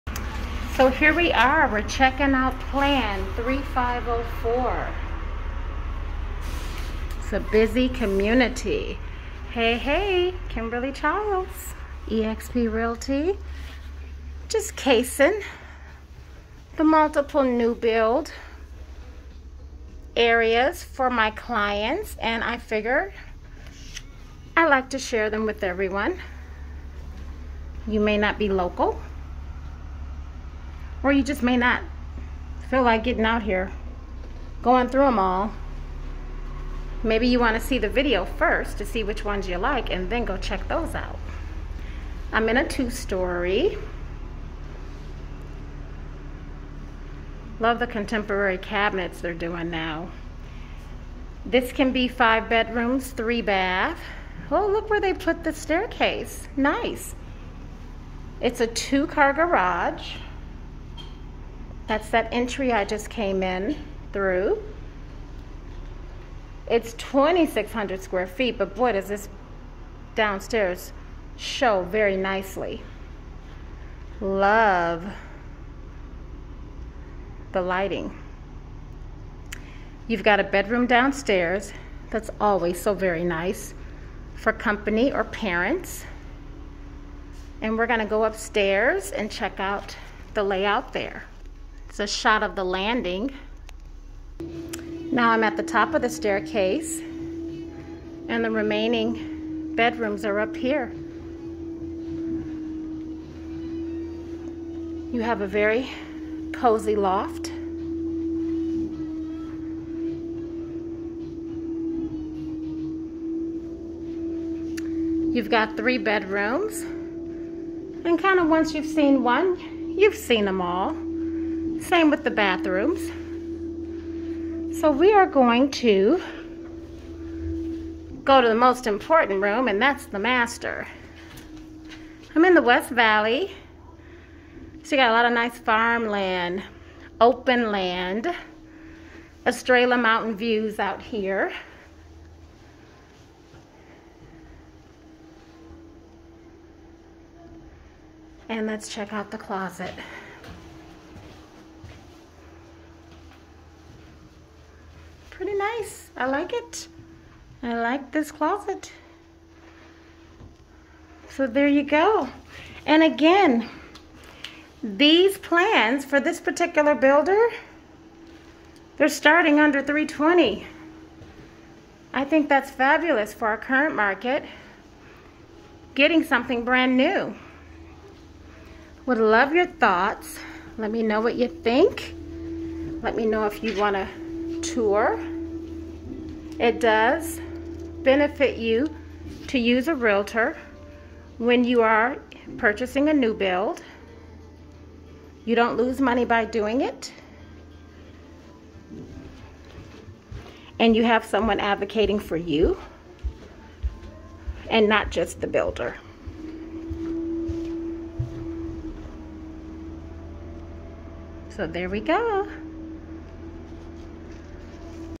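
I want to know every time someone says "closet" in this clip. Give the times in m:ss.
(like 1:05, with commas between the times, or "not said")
2:29, 2:38.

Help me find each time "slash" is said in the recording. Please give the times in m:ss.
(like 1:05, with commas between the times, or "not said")
not said.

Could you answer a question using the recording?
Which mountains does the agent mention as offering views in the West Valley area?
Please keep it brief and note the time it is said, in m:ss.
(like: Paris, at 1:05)
Estrella Mountain, at 2:19.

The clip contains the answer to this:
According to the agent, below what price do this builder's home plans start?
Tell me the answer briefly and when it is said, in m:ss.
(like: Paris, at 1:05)
320, at 2:49.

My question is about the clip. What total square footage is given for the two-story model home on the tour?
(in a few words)
2,600.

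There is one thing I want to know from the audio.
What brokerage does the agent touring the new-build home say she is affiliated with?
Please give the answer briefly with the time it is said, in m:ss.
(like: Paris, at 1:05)
eXp Realty, at 0:12.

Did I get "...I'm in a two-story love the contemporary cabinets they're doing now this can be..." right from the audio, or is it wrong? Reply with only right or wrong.
right.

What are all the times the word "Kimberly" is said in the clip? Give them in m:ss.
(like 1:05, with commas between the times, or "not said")
0:10.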